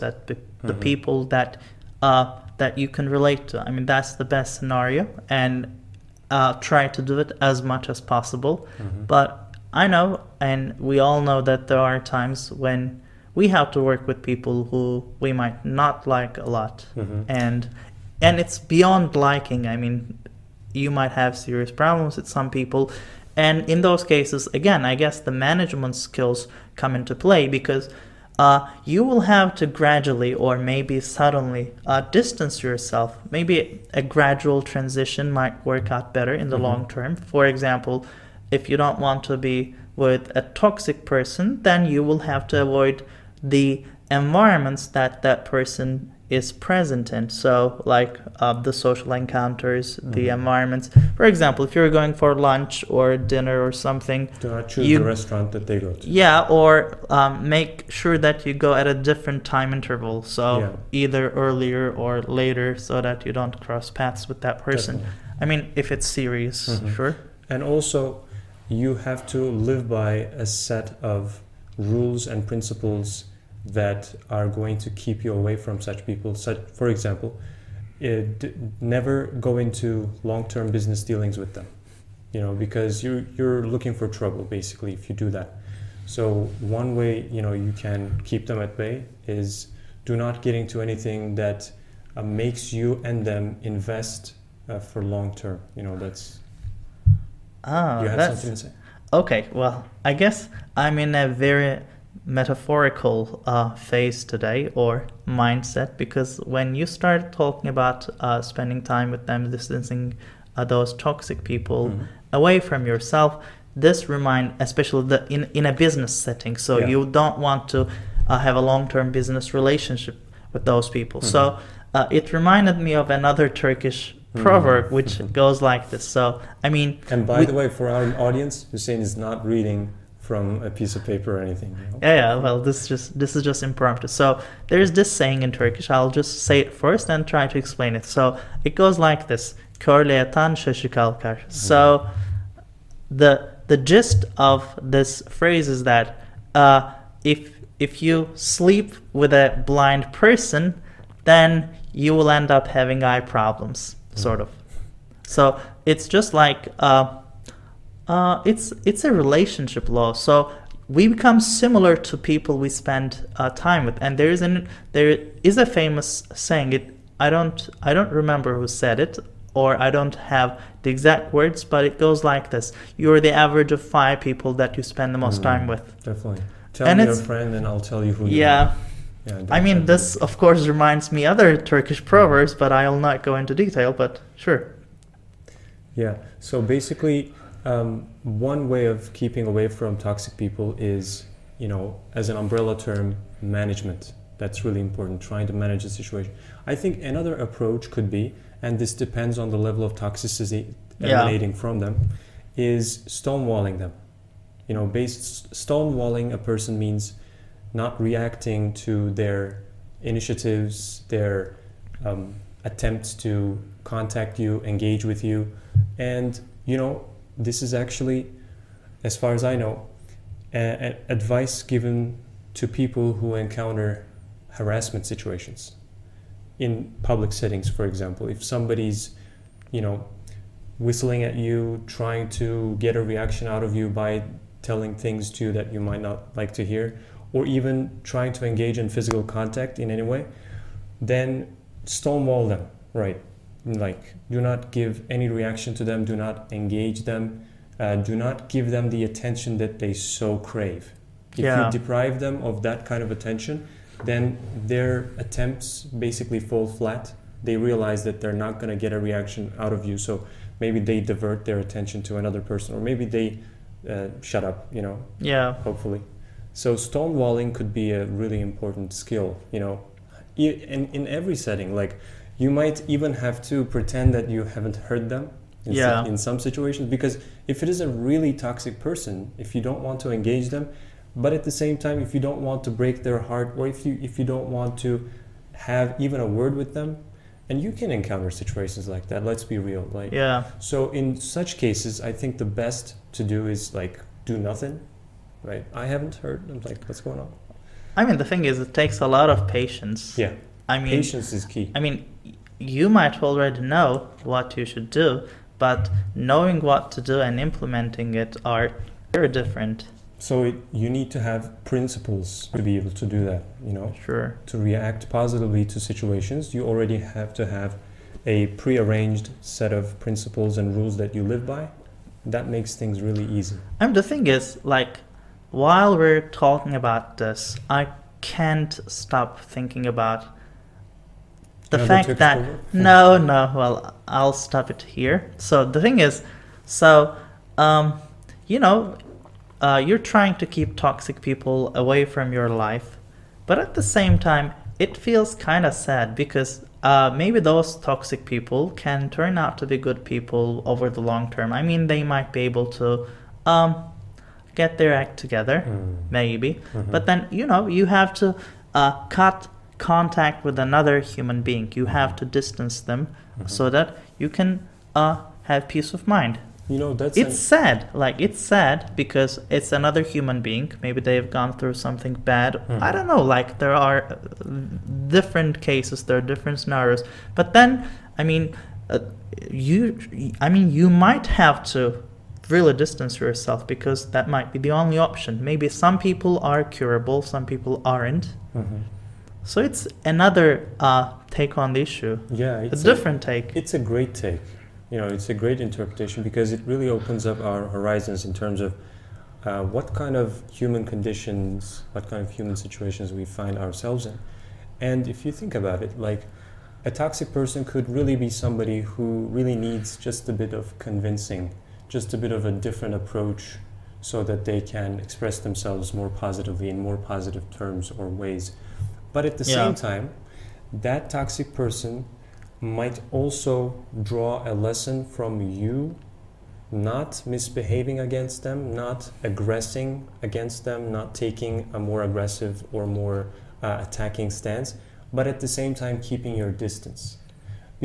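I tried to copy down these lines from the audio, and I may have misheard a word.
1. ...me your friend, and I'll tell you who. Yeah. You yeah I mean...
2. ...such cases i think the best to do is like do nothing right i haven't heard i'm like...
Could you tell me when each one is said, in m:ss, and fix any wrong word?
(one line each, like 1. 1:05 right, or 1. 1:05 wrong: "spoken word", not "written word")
1. 2:56 right
2. 4:51 right.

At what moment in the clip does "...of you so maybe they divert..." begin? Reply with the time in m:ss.
4:19.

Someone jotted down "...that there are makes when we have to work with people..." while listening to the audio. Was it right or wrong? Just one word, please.
wrong.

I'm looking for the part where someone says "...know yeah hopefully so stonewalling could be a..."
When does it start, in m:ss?
4:24.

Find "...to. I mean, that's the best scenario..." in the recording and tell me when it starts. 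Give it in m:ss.
0:03.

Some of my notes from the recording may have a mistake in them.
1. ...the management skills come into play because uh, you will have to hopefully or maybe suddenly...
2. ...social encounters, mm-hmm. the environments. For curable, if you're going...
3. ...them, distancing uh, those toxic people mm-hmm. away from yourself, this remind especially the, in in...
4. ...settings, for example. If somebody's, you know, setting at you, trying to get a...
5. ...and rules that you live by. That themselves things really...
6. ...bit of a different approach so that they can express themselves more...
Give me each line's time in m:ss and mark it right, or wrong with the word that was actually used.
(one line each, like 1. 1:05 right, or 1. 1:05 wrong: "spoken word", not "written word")
1. 0:25 wrong: "gradually", not "hopefully"
2. 0:48 wrong: "example", not "curable"
3. 1:49 right
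4. 3:47 wrong: "whistling", not "setting"
5. 5:20 wrong: "makes", not "themselves"
6. 6:52 right.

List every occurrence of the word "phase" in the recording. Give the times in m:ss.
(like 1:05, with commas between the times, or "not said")
1:43.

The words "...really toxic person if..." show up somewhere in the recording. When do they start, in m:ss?
4:37.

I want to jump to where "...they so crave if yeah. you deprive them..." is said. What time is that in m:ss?
4:09.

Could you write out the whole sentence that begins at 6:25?
Maybe some people are curable, some people aren't.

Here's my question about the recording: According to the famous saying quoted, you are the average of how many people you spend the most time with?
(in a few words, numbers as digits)
5.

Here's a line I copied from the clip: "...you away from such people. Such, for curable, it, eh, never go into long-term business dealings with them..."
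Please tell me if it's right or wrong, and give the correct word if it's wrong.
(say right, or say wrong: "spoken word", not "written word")
wrong: "example", not "curable".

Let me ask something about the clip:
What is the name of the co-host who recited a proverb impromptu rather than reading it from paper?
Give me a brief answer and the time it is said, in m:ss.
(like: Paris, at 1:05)
Huseyin, at 2:08.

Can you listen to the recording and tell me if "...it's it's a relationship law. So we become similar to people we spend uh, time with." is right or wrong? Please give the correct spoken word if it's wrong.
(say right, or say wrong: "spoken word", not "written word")
right.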